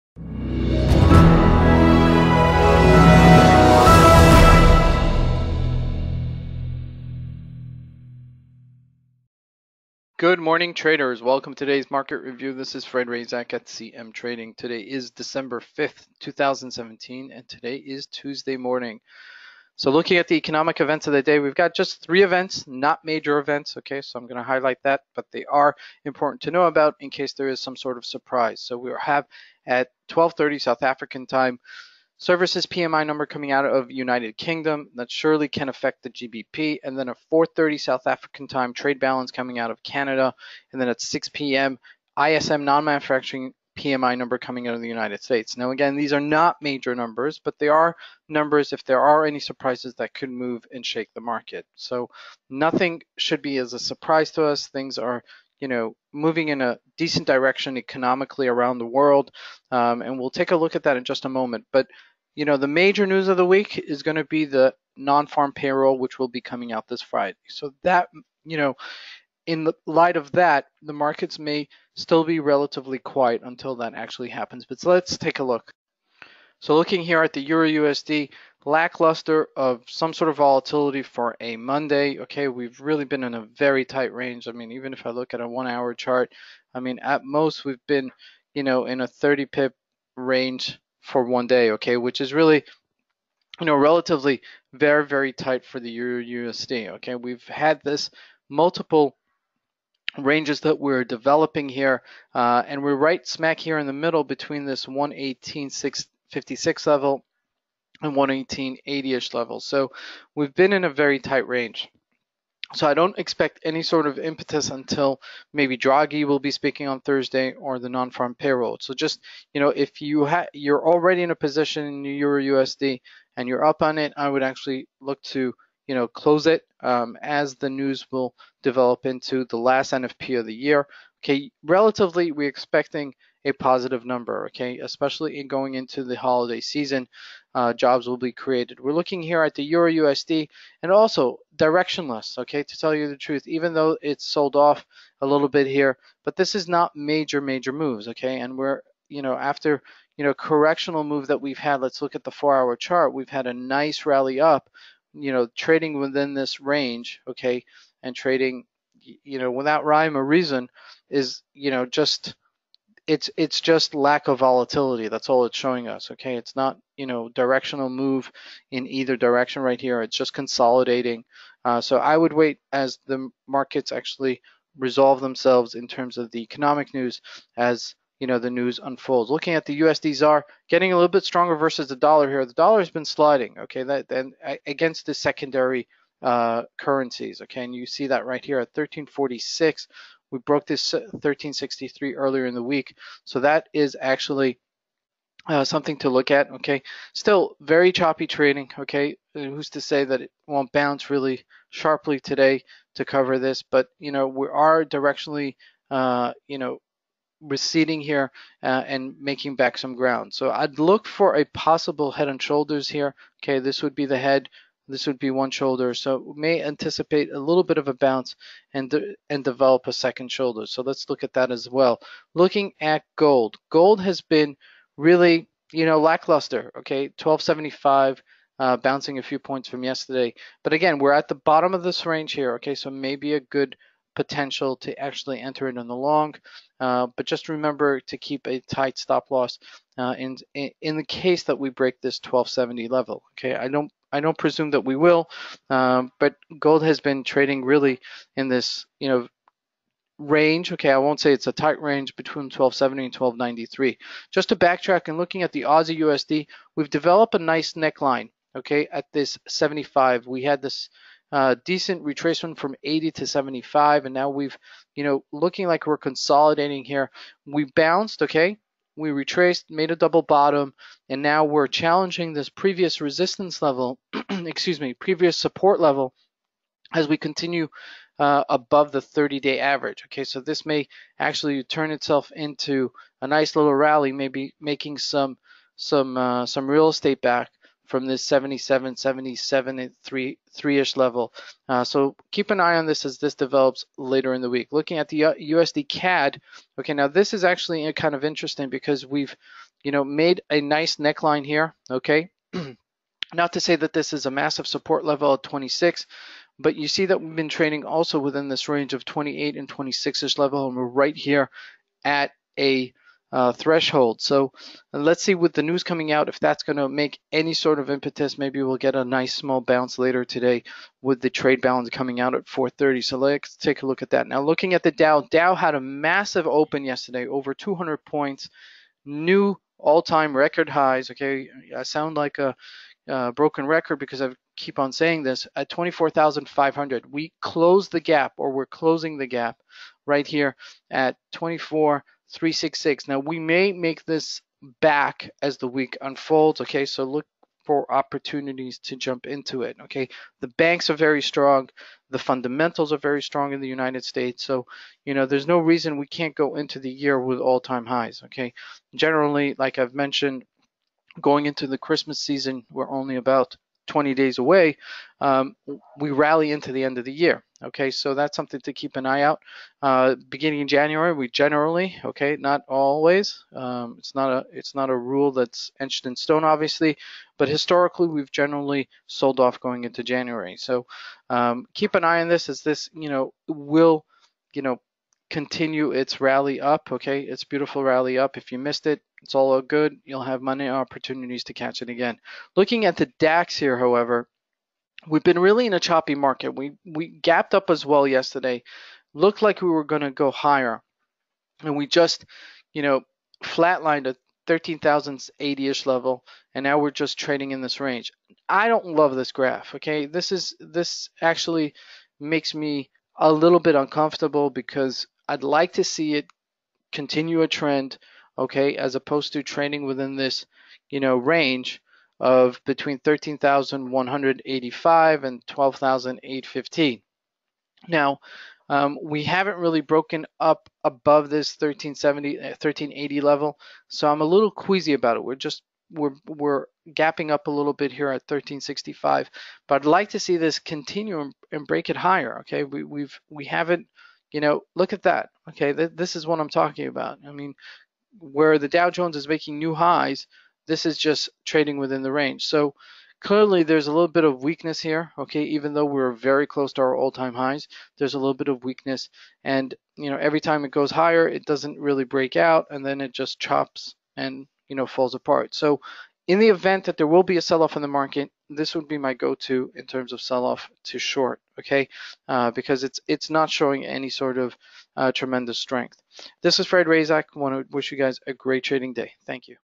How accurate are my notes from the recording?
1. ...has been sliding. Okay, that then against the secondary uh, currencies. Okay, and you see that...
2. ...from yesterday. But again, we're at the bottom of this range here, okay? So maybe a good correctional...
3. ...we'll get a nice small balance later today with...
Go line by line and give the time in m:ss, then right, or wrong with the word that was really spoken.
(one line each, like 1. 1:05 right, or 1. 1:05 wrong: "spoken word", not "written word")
1. 3:02 right
2. 3:49 wrong: "potential", not "correctional"
3. 5:18 wrong: "bounce", not "balance".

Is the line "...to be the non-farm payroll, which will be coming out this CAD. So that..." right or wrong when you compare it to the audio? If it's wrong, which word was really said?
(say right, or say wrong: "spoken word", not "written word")
wrong: "Friday", not "CAD".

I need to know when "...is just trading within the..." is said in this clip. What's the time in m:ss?
7:30.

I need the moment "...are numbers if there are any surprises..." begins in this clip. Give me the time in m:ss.
0:47.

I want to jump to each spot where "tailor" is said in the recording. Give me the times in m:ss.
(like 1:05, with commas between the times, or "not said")
not said.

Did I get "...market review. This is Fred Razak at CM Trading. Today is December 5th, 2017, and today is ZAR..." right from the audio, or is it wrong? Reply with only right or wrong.
wrong.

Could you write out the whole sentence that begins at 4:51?
Uh, so keep an eye on this as this develops later in the week.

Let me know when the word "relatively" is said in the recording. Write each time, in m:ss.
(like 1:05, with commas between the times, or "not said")
1:12, 1:33, 2:11.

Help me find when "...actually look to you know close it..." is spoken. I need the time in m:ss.
2:04.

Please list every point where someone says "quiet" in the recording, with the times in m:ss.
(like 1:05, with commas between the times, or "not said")
1:12.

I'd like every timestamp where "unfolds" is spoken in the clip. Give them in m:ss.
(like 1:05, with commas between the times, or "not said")
2:58, 5:46.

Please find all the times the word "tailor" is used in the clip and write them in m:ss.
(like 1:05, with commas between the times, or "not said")
not said.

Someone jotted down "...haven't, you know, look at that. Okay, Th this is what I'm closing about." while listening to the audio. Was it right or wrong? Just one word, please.
wrong.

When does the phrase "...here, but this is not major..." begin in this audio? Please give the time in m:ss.
2:25.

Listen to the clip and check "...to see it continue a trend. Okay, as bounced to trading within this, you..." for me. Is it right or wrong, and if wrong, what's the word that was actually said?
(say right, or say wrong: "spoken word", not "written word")
wrong: "opposed", not "bounced".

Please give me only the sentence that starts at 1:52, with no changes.
So I don't expect any sort of impetus until maybe Draghi will be speaking on Thursday or the non-farm payroll.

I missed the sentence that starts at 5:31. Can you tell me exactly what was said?
Okay, I sound like a uh, broken record because I keep on saying this at 24,500.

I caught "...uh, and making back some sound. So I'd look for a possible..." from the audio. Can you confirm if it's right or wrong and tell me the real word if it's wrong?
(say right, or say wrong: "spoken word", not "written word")
wrong: "ground", not "sound".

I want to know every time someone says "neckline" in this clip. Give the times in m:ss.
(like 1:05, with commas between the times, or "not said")
4:17, 5:00.